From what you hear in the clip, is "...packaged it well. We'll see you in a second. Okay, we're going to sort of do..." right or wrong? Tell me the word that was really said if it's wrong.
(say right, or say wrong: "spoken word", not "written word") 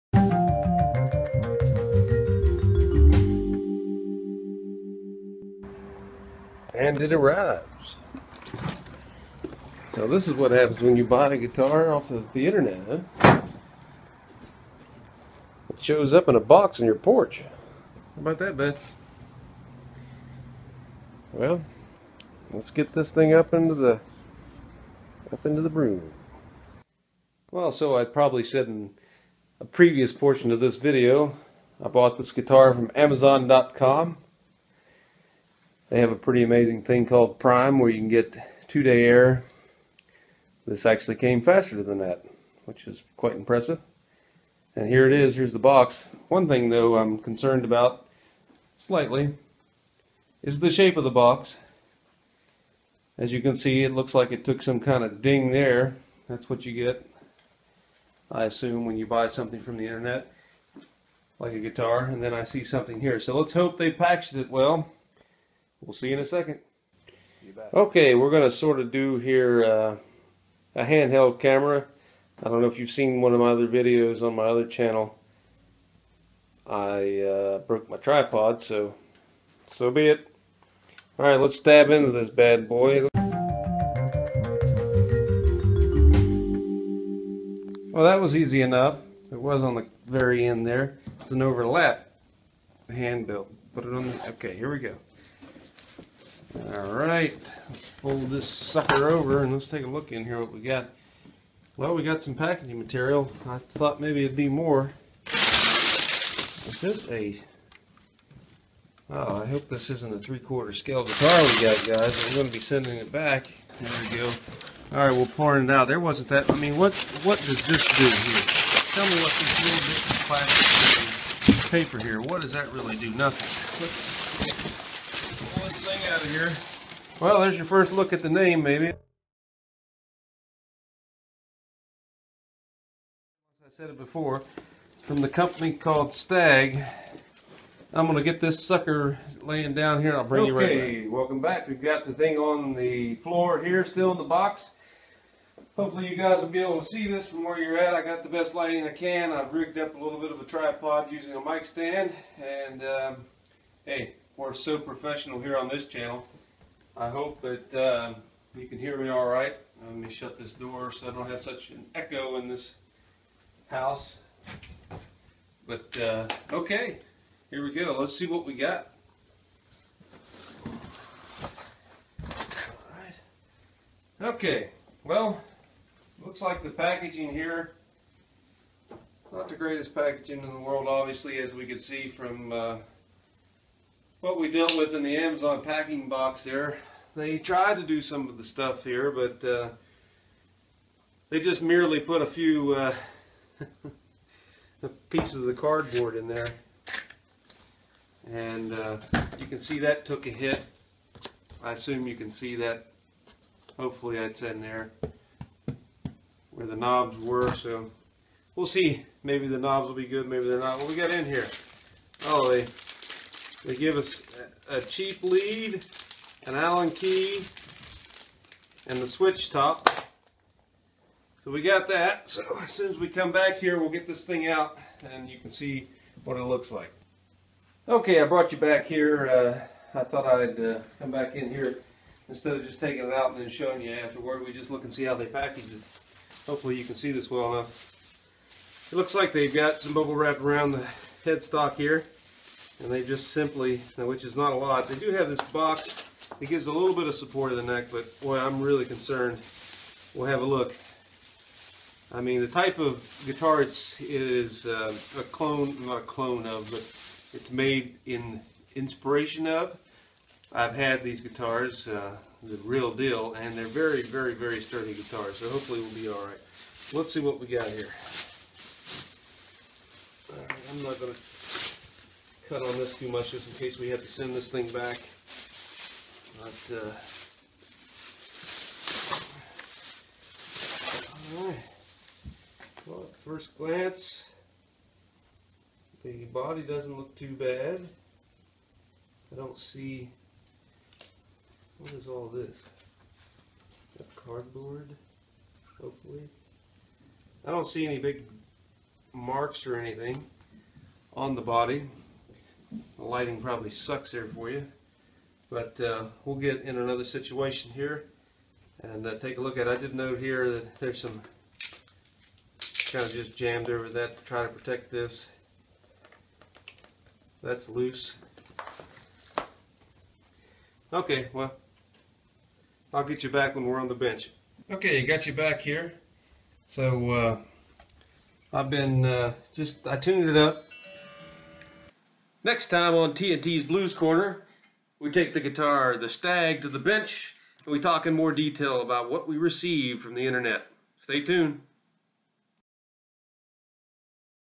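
right.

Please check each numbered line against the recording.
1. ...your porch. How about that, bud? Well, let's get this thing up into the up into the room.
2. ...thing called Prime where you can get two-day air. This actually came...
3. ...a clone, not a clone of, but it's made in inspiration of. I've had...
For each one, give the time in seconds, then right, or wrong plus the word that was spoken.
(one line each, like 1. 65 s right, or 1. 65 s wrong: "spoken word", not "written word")
1. 16 s right
2. 36 s right
3. 255 s right.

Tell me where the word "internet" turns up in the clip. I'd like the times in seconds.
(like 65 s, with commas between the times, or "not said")
12 s, 59 s, 340 s.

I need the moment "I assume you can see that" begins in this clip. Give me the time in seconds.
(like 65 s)
201 s.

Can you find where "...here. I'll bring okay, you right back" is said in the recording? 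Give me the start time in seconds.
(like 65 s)
140 s.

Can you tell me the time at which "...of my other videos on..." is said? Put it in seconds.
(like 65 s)
73 s.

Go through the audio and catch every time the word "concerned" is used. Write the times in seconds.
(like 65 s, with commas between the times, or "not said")
47 s, 248 s.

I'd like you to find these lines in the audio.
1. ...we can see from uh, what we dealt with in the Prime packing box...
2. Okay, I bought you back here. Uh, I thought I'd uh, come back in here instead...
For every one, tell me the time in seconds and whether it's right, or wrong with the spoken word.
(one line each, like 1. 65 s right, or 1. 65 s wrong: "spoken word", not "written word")
1. 181 s wrong: "Amazon", not "Prime"
2. 227 s wrong: "brought", not "bought".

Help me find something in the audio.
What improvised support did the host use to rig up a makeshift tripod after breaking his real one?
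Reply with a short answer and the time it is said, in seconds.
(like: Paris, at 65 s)
a mic stand, at 151 s.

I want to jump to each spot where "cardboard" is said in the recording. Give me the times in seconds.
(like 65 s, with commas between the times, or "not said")
195 s, 294 s.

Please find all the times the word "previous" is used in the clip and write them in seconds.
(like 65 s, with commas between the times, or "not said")
29 s.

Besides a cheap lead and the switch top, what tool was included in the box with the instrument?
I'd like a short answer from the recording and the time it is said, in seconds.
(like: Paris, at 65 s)
an Allen key, at 216 s.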